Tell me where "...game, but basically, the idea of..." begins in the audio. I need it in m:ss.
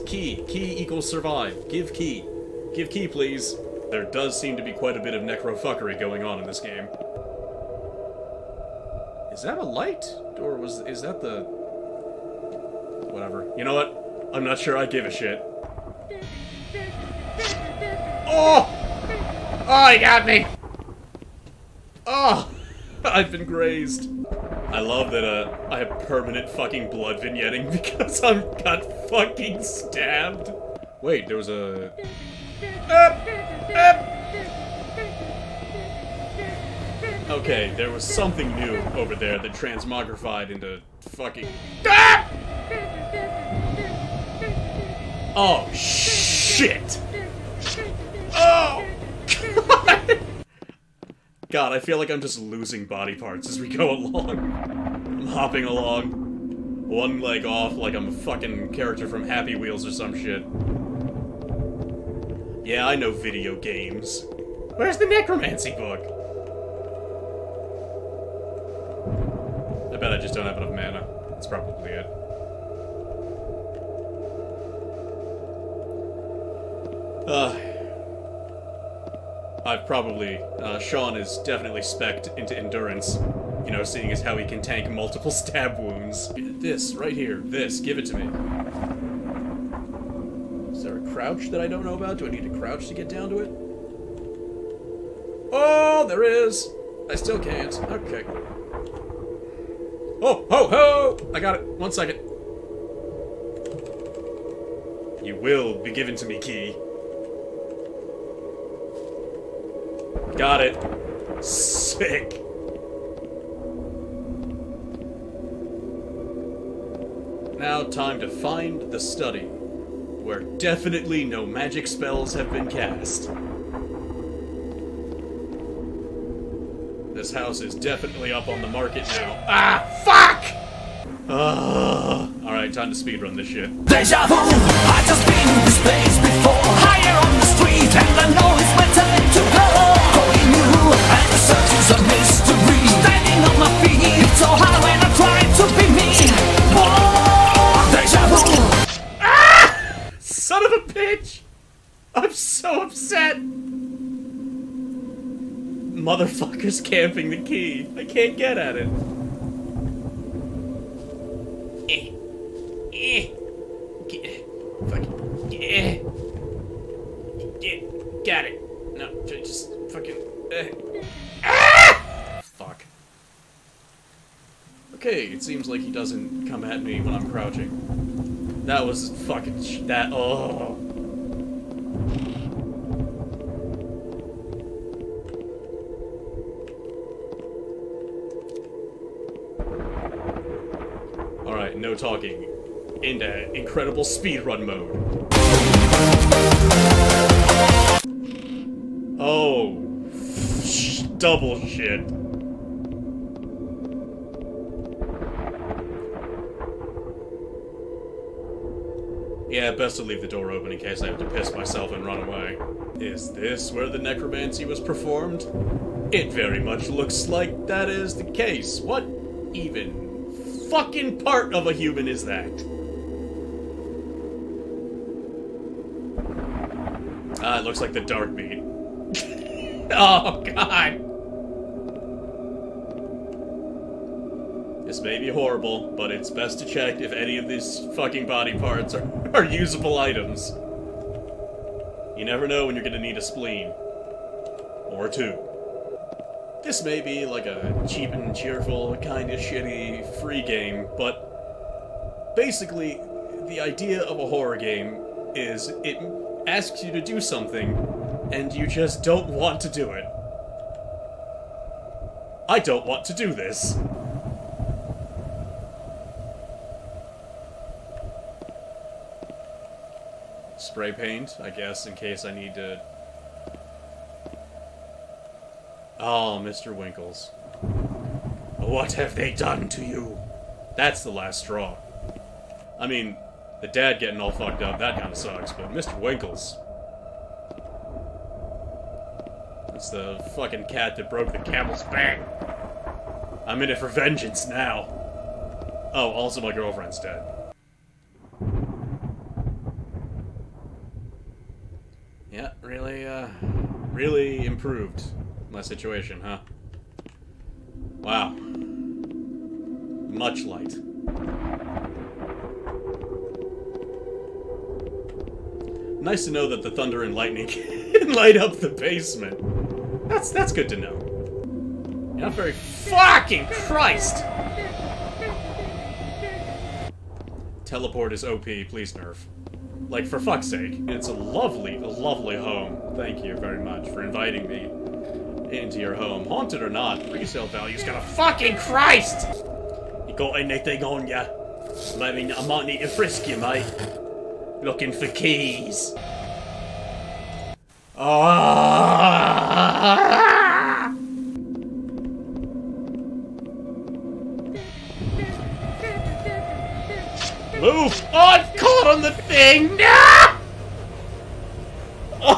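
4:10.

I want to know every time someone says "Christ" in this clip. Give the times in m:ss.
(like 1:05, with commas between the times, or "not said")
5:23, 5:38.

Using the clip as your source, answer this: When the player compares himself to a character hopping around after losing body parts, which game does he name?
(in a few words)
Happy Wheels.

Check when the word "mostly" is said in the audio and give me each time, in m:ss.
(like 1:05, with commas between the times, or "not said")
not said.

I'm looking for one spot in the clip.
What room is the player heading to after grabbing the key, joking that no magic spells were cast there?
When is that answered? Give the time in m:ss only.
1:58.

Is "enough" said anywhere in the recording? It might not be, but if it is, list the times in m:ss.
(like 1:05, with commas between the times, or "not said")
1:10.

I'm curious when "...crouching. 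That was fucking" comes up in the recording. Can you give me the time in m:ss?
2:57.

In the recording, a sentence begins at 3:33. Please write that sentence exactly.
Is this where the necromancy was performed?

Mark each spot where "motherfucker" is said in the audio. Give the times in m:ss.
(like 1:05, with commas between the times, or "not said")
2:36.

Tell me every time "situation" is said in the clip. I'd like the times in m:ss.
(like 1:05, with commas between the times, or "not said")
5:05.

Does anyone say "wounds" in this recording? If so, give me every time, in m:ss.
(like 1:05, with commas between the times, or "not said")
1:25.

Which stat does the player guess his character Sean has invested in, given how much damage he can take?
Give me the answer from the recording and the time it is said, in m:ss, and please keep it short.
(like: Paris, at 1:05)
Endurance, at 1:22.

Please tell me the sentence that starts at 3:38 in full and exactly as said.
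What even fucking part of a human is that?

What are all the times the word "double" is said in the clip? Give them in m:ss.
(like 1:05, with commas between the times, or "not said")
3:21.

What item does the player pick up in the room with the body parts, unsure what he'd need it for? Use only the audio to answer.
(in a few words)
Spray paint.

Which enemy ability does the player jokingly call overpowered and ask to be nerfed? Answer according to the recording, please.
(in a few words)
Teleport.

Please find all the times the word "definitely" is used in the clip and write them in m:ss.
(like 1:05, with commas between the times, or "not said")
1:21, 2:00, 2:07.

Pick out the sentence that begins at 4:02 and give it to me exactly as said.
You never know when you're gonna need a spleen.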